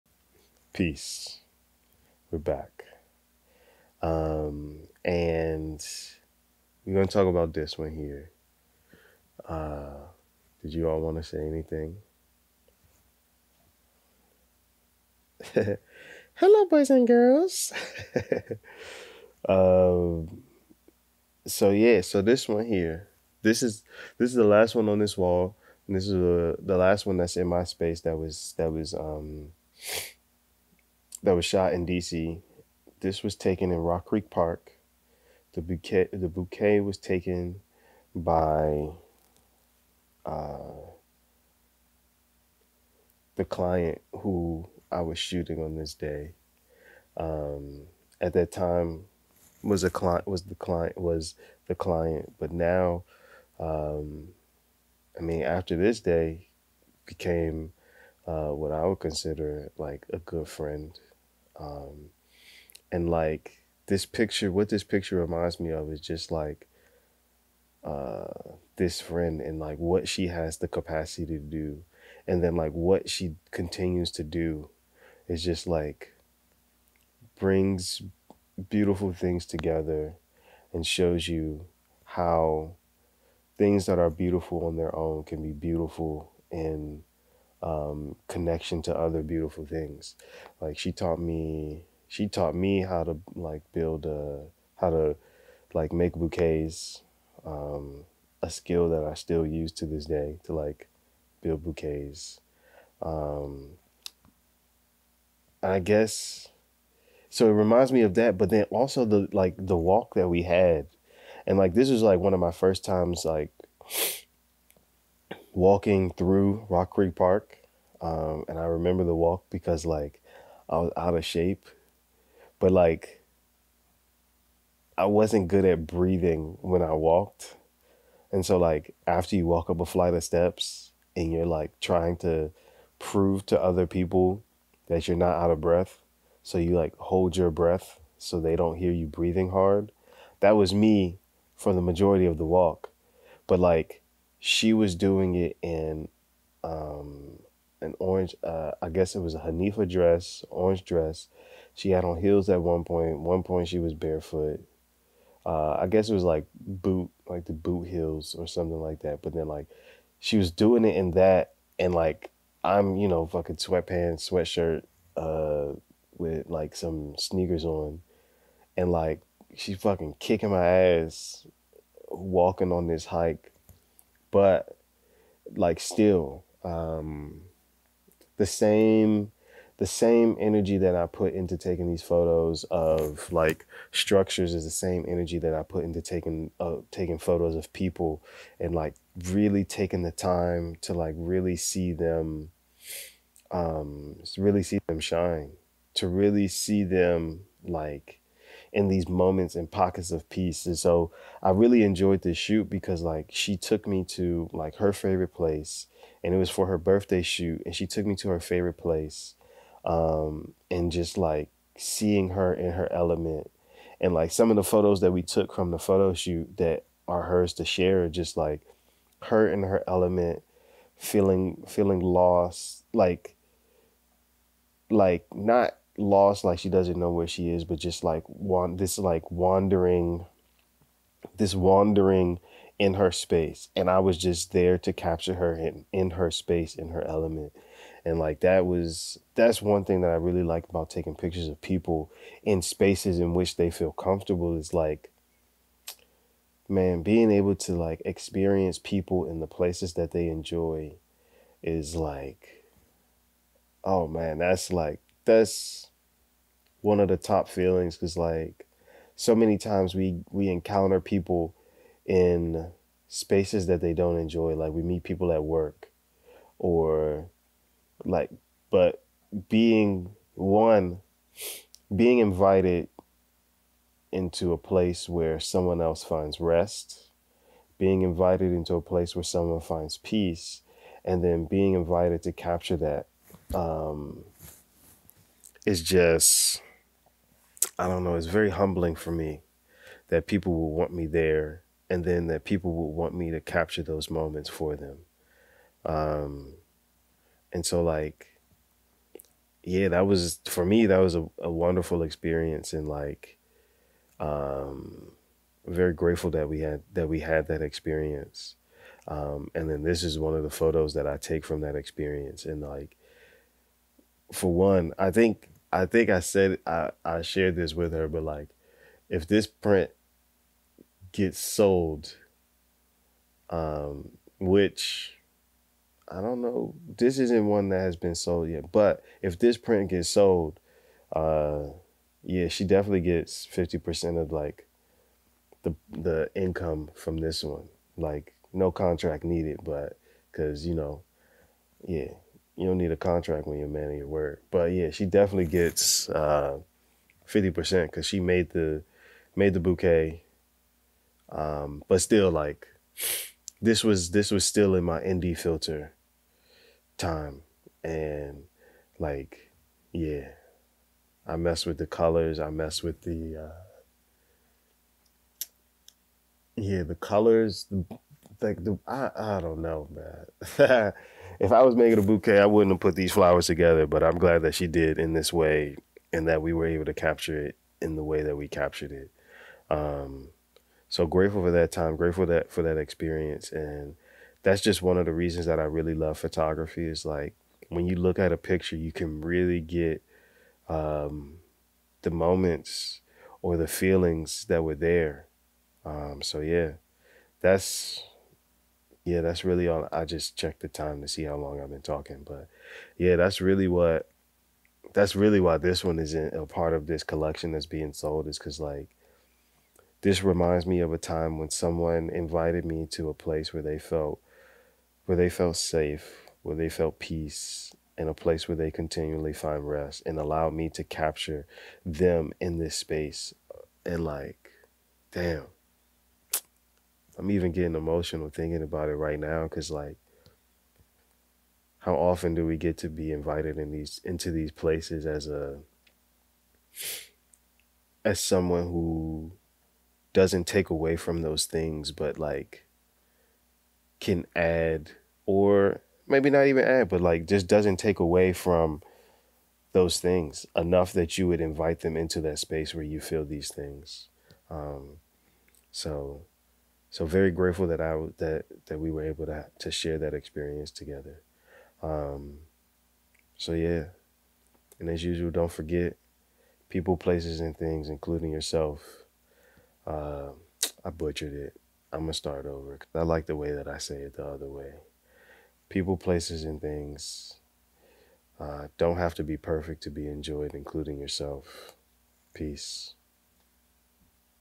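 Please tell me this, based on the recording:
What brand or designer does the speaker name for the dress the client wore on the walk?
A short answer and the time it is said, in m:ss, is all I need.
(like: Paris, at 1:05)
Hanifa, at 2:29.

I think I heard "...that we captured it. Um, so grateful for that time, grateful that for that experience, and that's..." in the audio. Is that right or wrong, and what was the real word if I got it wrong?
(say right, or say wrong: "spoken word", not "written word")
right.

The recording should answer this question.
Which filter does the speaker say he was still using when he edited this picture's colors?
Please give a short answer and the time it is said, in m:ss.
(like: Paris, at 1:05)
Indie filter, at 5:55.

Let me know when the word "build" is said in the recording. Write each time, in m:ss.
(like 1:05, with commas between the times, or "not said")
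1:33, 1:41.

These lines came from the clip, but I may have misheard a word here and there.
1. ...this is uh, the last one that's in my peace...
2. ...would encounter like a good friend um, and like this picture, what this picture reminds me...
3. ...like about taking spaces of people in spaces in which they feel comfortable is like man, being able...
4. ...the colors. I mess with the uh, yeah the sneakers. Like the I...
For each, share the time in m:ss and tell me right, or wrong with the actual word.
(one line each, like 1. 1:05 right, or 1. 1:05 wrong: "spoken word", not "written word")
1. 0:25 wrong: "space", not "peace"
2. 0:58 wrong: "consider", not "encounter"
3. 4:00 wrong: "pictures", not "spaces"
4. 6:01 wrong: "colors", not "sneakers".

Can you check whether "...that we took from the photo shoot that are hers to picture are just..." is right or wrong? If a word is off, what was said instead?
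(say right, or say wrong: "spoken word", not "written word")
wrong: "share", not "picture".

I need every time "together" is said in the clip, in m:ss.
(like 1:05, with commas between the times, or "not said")
1:19, 6:13, 7:40.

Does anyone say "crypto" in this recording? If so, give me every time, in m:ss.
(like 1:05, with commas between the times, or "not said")
not said.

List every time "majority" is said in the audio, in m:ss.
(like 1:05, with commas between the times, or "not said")
2:21.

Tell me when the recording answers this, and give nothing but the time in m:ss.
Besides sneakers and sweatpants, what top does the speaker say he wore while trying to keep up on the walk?
2:44.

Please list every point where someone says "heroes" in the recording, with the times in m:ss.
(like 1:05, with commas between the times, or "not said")
not said.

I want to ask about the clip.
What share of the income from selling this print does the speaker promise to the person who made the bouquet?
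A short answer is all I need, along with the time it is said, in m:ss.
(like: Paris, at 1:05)
50%, at 5:33.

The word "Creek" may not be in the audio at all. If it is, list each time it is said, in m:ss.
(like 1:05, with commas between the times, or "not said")
0:34, 1:56.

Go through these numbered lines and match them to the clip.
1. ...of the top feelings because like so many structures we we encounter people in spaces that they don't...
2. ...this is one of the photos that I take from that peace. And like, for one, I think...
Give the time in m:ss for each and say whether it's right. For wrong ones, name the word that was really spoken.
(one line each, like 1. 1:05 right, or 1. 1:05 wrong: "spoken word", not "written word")
1. 4:16 wrong: "times", not "structures"
2. 5:09 wrong: "experience", not "peace".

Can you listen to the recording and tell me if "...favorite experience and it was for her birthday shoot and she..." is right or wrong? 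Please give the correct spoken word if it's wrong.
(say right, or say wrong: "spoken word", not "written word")
wrong: "place", not "experience".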